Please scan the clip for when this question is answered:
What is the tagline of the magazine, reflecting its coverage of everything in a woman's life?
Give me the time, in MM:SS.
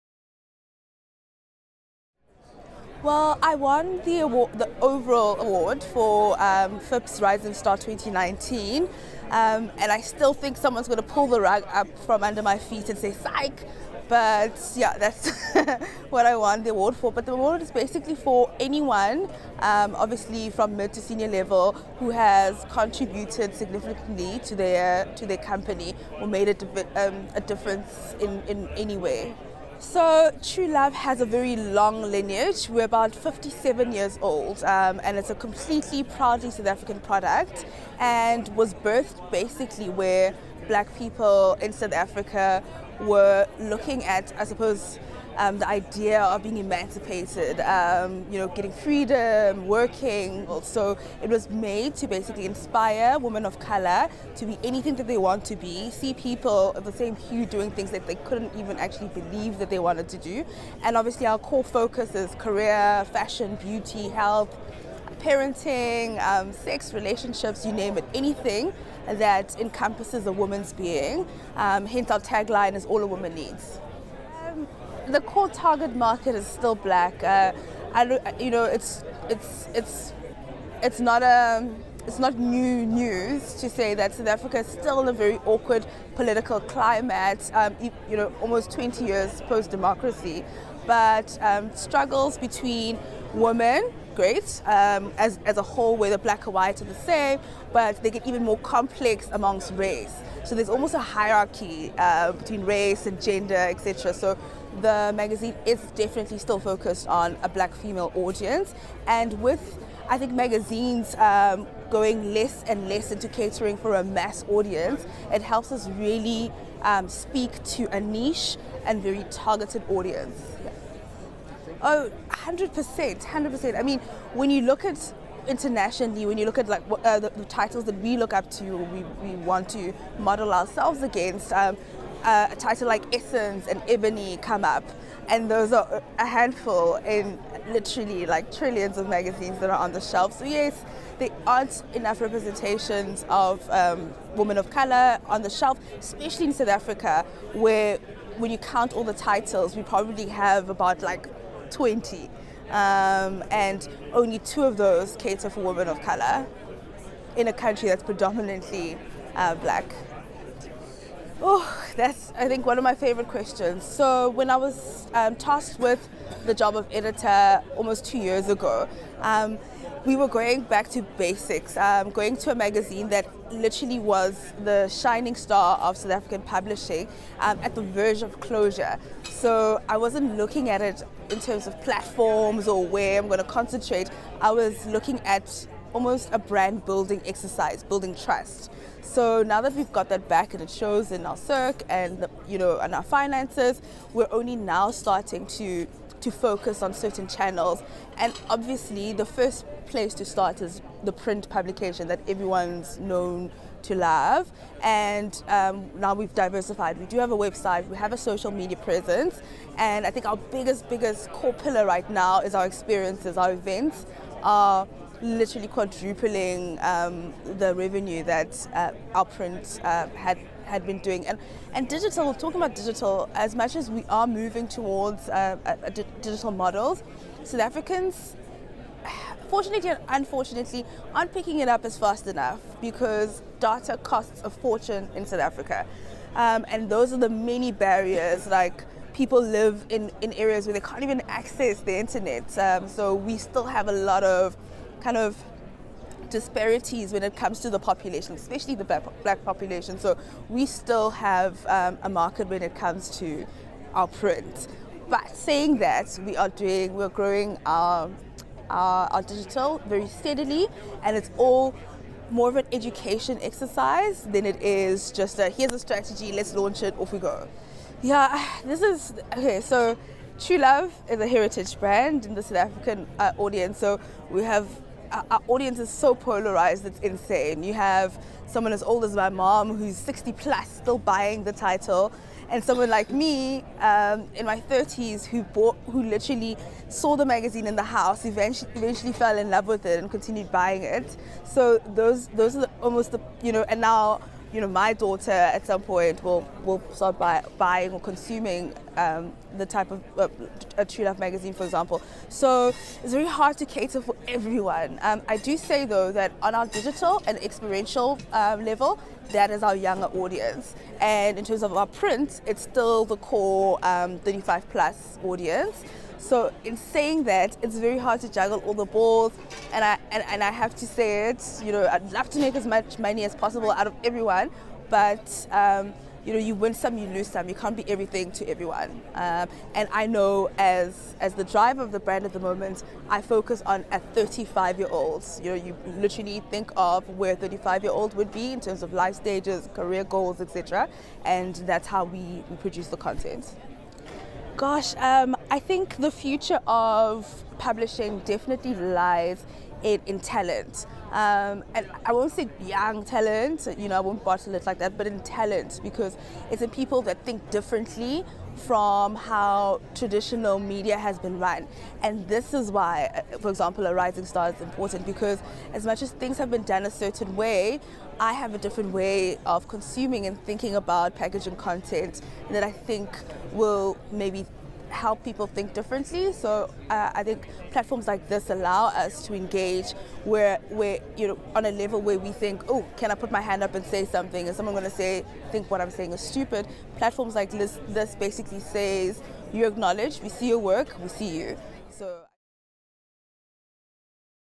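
01:12.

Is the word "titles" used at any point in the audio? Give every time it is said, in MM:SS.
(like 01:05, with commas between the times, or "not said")
02:07, 02:12, 02:29, 04:41.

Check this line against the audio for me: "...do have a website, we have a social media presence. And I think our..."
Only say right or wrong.
right.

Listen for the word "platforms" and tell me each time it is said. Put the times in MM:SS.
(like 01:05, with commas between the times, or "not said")
03:01, 06:17, 06:26.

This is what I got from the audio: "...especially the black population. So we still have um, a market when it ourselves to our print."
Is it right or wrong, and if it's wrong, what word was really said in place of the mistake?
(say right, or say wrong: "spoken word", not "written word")
wrong: "comes", not "ourselves".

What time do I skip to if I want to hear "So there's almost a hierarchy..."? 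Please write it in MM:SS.
01:40.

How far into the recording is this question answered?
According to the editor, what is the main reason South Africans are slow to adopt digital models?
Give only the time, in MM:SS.
03:53.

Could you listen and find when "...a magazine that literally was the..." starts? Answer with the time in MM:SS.
02:52.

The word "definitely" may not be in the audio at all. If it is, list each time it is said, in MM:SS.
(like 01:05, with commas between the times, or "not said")
01:45, 05:48.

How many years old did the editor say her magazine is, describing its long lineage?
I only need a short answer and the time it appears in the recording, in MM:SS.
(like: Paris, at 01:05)
57, at 00:33.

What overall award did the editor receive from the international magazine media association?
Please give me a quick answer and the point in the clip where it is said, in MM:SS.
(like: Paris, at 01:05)
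FIPP's Rising Star 2019, at 00:06.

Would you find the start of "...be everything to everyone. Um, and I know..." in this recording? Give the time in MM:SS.
05:27.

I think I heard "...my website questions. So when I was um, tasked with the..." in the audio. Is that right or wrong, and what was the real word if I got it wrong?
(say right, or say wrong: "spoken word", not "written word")
wrong: "favorite", not "website".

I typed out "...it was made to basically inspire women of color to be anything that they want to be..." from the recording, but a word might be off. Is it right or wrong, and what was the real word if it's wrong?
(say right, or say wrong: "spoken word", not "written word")
right.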